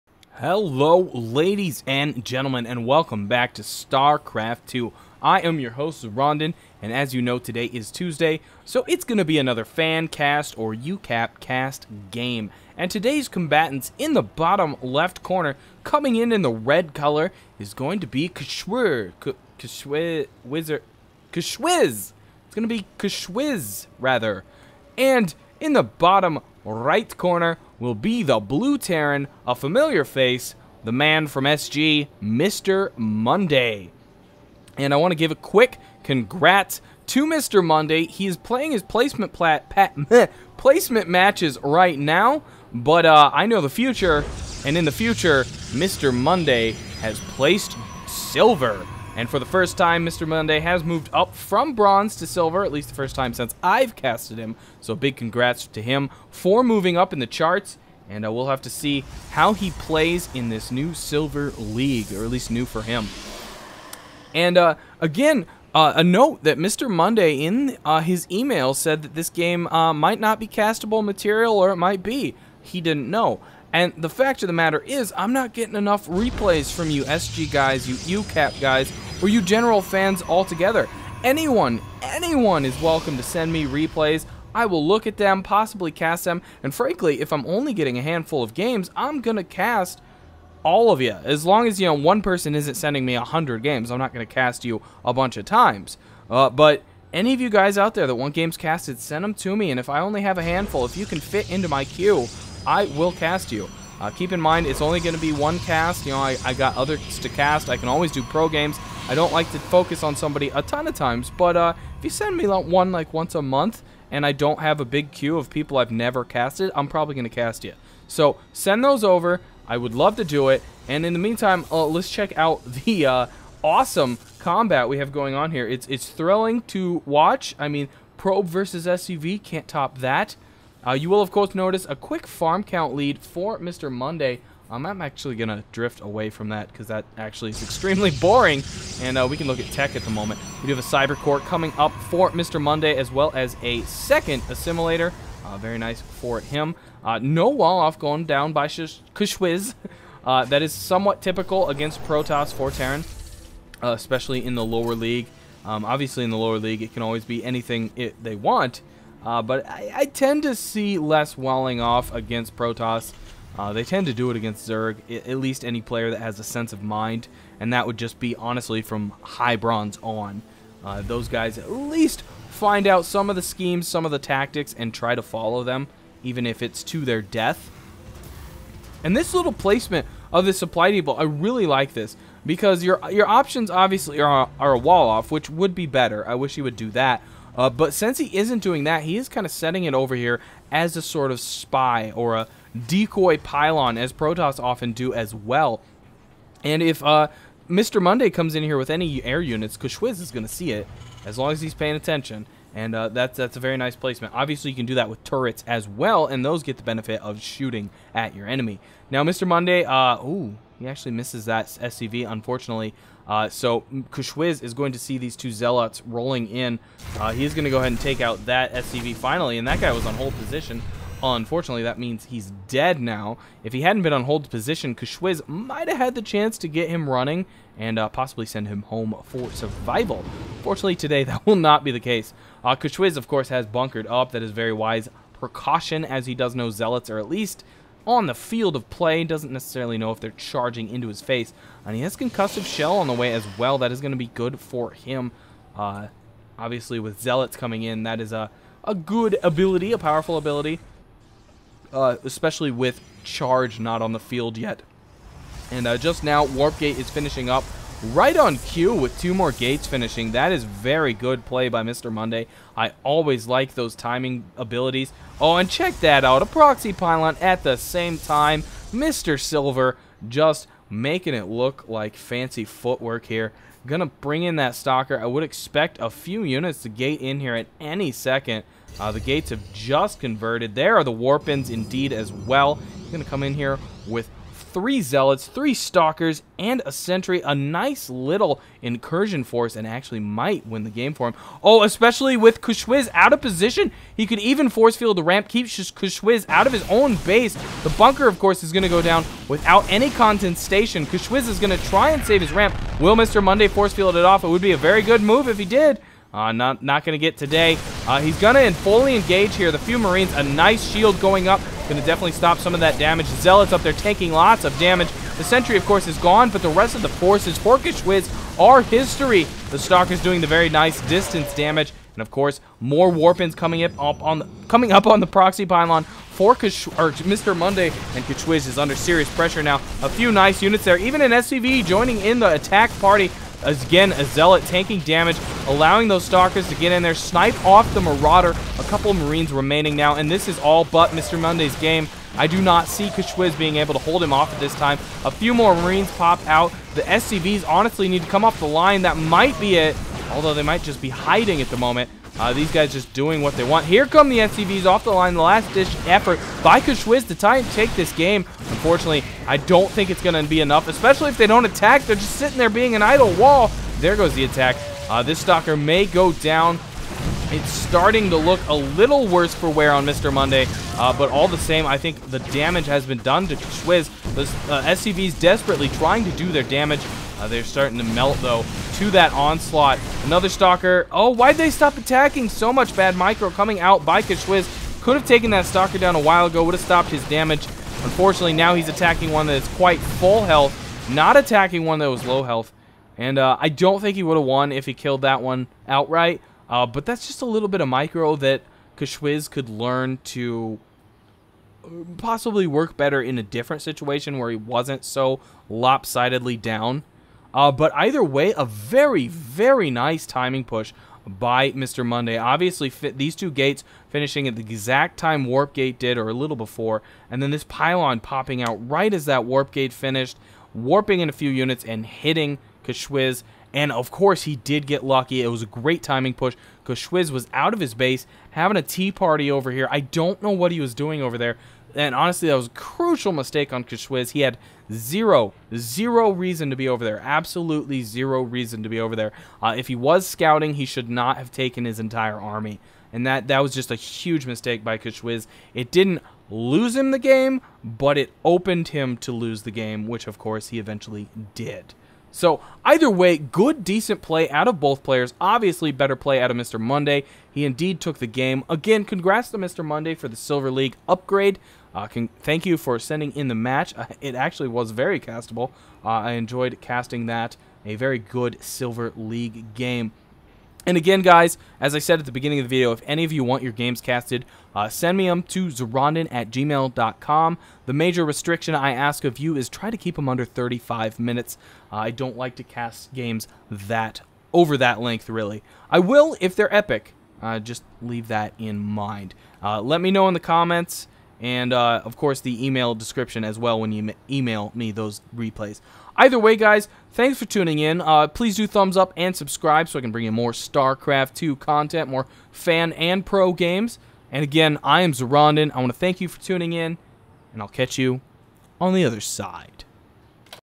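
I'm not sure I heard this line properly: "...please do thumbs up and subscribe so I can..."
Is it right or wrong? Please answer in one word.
right.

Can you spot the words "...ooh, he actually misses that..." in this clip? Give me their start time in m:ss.
3:30.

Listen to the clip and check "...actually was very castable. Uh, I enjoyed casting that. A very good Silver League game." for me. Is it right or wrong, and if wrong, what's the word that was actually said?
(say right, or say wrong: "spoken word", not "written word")
right.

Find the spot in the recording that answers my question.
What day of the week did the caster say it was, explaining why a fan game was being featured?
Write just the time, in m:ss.
0:07.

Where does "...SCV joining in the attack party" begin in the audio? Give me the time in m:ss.
5:31.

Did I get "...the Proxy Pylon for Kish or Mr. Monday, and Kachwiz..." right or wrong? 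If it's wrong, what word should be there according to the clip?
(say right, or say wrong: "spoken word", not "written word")
right.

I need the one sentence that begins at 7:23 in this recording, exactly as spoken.
And that, that was just a huge mistake by Kishwiz.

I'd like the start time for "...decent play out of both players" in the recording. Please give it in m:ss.
7:33.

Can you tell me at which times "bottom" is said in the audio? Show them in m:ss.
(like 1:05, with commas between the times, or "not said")
0:14, 0:25.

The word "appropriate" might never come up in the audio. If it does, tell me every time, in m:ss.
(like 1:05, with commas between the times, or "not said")
not said.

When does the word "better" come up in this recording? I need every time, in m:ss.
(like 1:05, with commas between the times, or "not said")
3:05, 6:42, 7:35.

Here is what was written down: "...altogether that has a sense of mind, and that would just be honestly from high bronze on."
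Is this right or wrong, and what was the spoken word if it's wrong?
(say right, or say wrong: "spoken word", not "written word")
wrong: "player", not "altogether".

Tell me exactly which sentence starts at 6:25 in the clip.
Could have taken that Stalker down a while ago.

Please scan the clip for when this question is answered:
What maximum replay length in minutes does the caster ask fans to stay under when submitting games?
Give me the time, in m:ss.
8:00.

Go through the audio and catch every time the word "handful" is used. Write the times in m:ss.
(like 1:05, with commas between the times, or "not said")
1:28, 1:40.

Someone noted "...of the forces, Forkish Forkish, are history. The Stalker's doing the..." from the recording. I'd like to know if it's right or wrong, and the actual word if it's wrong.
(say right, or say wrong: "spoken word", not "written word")
wrong: "Wiz", not "Forkish".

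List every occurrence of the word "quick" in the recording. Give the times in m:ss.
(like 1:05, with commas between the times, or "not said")
0:35, 2:11.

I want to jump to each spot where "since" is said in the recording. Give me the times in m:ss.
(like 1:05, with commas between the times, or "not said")
0:53, 3:07.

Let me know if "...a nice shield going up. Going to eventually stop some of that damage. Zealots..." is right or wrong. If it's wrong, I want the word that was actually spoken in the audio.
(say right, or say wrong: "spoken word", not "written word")
wrong: "definitely", not "eventually".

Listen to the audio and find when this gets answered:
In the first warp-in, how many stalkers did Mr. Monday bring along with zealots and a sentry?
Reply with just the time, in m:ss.
4:45.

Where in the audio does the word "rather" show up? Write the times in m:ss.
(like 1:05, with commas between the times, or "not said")
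0:23.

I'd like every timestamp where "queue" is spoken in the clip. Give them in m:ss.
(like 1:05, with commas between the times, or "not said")
1:41, 1:55.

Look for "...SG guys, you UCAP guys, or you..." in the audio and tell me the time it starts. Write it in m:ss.
1:17.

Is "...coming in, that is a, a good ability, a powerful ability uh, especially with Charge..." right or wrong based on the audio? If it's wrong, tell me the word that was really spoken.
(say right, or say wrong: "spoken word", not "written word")
right.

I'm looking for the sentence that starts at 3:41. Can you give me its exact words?
Unfortunately, that means he's dead now.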